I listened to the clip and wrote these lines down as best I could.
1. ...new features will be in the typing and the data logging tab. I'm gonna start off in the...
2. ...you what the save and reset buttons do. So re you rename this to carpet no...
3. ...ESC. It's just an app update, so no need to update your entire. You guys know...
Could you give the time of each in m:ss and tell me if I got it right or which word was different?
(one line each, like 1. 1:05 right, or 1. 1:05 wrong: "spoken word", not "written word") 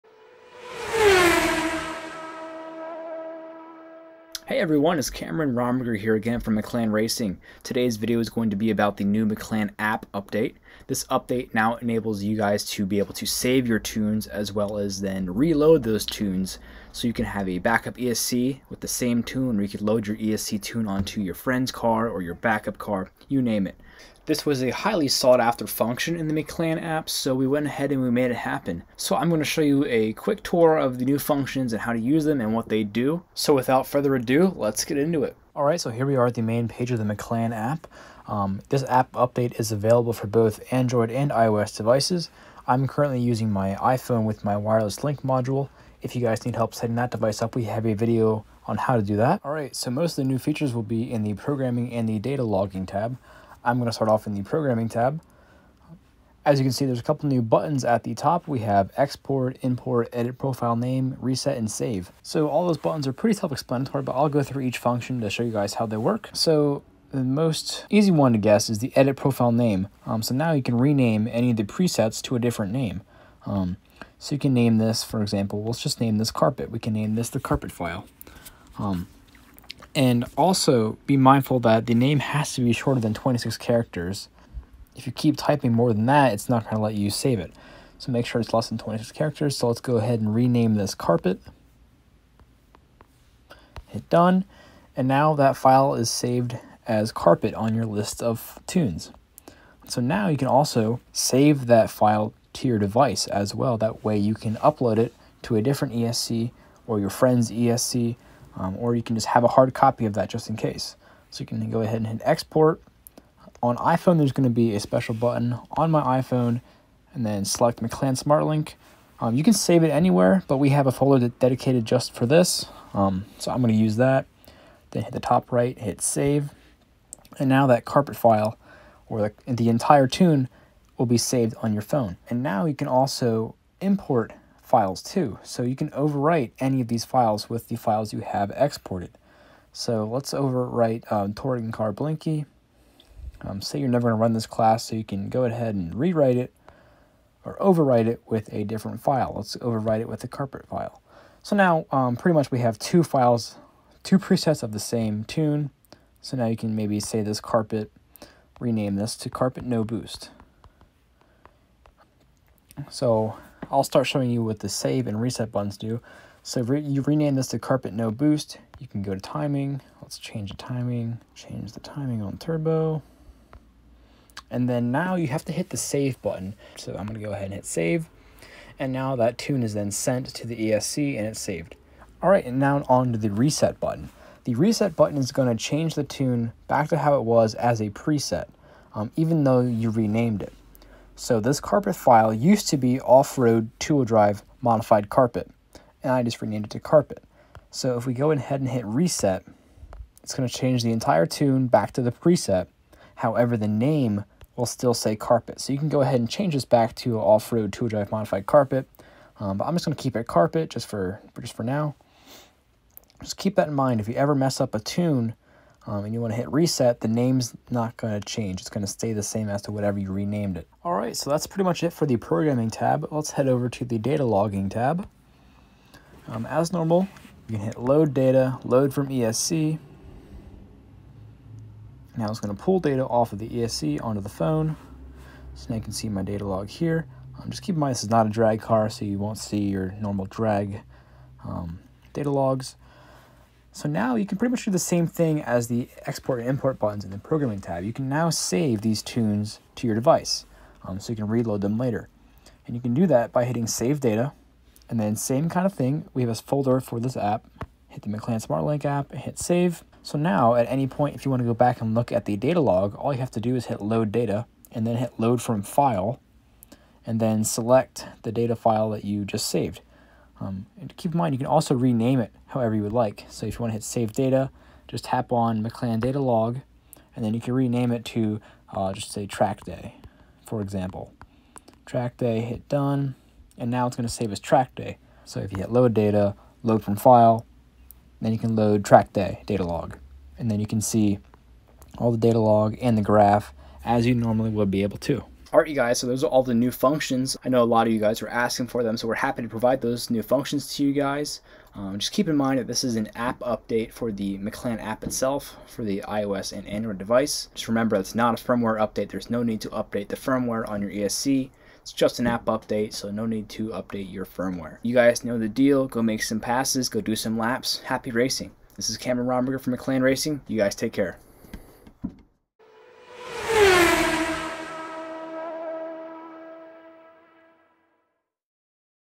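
1. 0:50 wrong: "programming", not "typing"
2. 2:44 right
3. 5:10 wrong: "firmware", not "entire".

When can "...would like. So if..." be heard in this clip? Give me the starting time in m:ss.
4:32.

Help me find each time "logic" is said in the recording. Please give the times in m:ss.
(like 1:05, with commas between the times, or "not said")
not said.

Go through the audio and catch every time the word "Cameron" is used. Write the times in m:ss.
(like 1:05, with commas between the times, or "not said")
0:05, 5:18.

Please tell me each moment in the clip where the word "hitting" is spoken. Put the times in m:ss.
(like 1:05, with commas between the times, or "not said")
4:13.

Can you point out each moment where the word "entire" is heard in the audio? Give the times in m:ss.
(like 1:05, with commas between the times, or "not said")
2:09, 3:20.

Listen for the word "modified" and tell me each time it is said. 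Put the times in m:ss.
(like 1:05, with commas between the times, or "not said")
3:14, 3:28.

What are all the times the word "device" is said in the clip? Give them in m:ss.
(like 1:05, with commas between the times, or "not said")
0:41, 0:47, 1:42, 4:09, 5:06.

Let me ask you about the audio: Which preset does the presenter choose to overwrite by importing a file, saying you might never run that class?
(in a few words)
Touring Car Blinky.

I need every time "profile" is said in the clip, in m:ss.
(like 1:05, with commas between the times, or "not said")
1:00, 1:09.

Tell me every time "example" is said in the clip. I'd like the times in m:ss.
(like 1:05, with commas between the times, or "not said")
1:15, 4:40.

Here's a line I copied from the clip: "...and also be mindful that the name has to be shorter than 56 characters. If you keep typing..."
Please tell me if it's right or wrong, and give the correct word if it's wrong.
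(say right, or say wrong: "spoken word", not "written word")
wrong: "26", not "56".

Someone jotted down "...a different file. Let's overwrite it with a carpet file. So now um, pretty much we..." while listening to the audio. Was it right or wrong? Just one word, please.
right.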